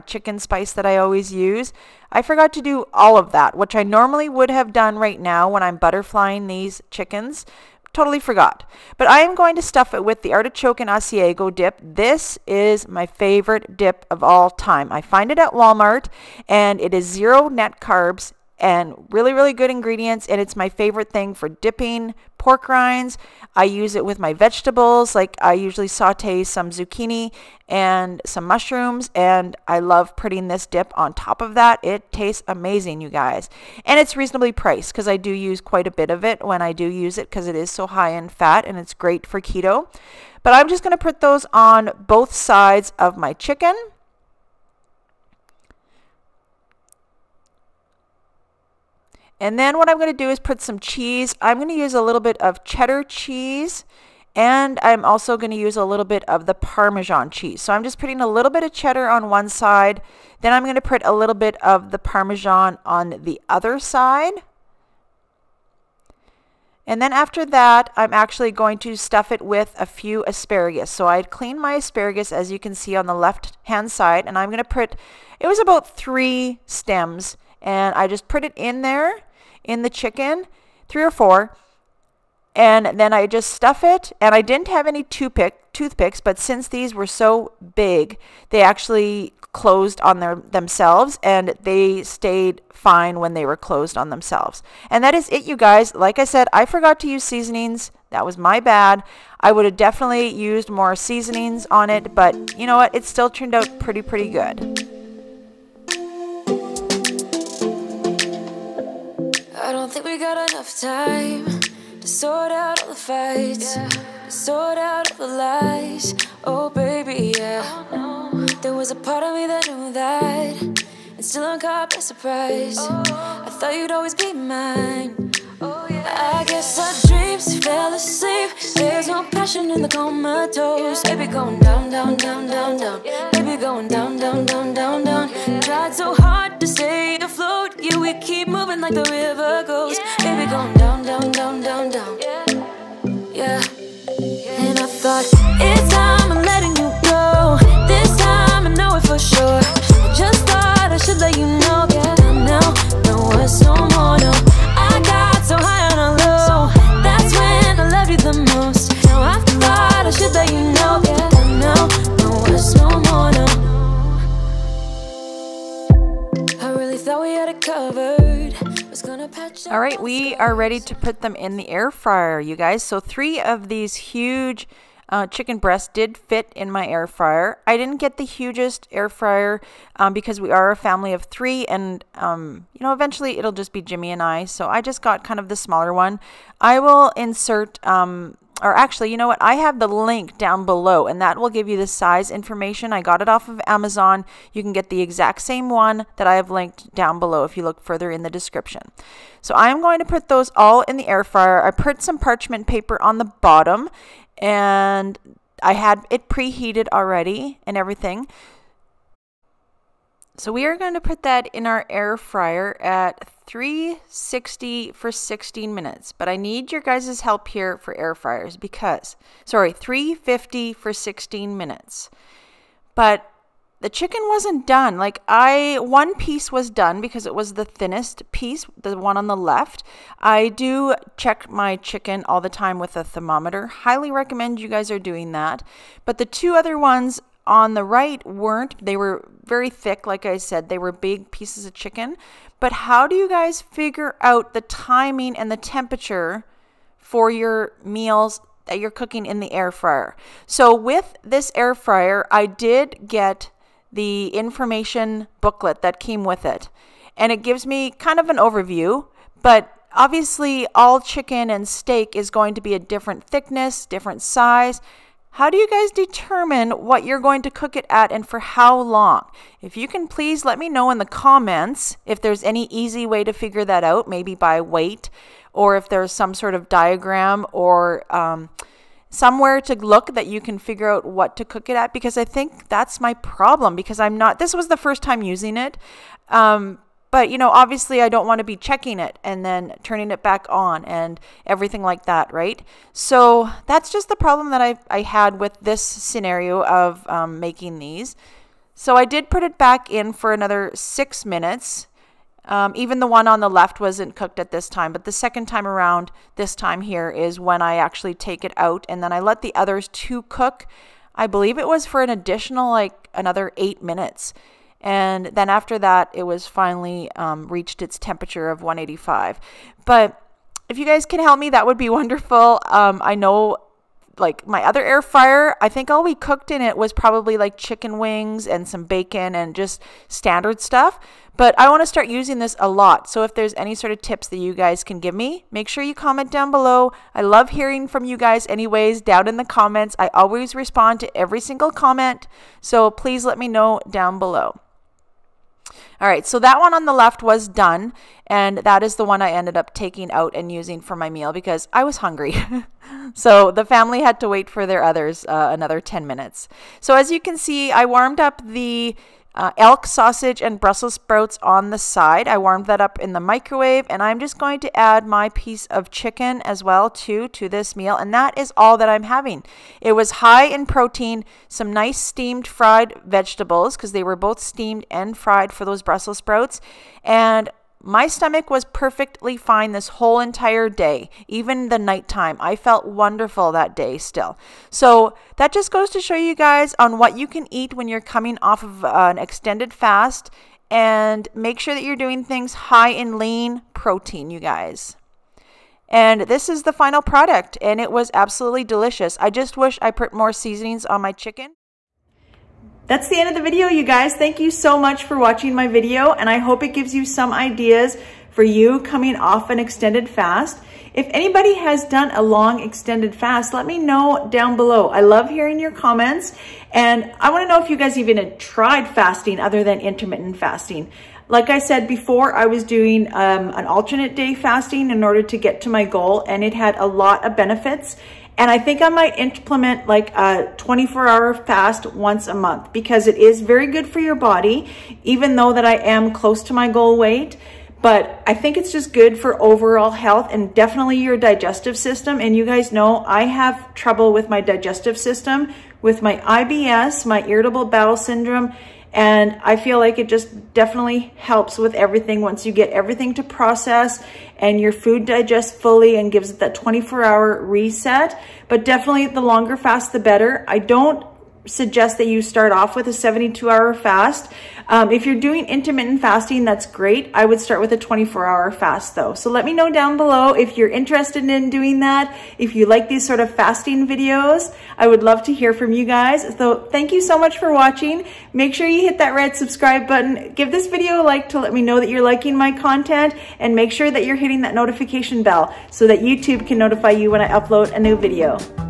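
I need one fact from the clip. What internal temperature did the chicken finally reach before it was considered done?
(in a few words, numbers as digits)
185.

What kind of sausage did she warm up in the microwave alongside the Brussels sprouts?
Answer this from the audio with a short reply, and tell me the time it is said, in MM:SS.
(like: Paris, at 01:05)
elk sausage, at 05:59.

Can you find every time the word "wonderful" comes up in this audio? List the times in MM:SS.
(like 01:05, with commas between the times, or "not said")
05:21, 06:22.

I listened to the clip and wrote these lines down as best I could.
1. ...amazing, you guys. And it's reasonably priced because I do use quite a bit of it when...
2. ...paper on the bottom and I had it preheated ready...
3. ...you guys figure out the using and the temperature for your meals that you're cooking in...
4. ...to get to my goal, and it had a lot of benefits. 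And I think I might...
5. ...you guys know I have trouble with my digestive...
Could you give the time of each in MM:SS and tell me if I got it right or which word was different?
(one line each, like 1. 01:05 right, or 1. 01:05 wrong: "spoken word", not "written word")
1. 00:32 right
2. 03:22 wrong: "already", not "ready"
3. 04:03 wrong: "timing", not "using"
4. 07:05 right
5. 07:22 right.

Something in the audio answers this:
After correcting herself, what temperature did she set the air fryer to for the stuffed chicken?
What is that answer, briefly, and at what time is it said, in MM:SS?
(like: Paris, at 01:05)
350, at 03:39.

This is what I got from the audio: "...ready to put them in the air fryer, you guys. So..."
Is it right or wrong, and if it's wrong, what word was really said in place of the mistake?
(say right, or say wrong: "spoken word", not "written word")
right.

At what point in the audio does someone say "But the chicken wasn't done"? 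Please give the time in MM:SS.
03:42.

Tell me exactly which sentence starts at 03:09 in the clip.
I have the link down below and that will give you the size information.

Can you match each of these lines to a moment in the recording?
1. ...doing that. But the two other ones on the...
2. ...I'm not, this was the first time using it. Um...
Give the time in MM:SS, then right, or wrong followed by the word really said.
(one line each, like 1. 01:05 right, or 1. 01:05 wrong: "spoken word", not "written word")
1. 03:54 right
2. 04:43 right.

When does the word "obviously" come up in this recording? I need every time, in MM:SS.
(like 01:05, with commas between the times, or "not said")
04:19, 04:47.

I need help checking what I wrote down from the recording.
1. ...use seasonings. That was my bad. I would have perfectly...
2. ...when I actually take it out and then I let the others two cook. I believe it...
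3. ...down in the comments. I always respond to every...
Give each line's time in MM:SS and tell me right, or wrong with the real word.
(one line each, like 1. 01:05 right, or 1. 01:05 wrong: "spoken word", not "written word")
1. 01:37 wrong: "definitely", not "perfectly"
2. 05:07 right
3. 05:38 right.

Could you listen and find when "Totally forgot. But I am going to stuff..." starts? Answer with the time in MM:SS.
00:07.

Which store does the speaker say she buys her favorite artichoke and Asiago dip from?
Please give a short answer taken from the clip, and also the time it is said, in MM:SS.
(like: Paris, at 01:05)
Walmart, at 00:15.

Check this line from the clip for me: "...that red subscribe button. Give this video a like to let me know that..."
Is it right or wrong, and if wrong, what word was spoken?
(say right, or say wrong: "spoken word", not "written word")
right.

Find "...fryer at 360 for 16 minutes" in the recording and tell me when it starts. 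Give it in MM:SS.
03:32.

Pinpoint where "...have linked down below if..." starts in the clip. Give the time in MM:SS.
03:16.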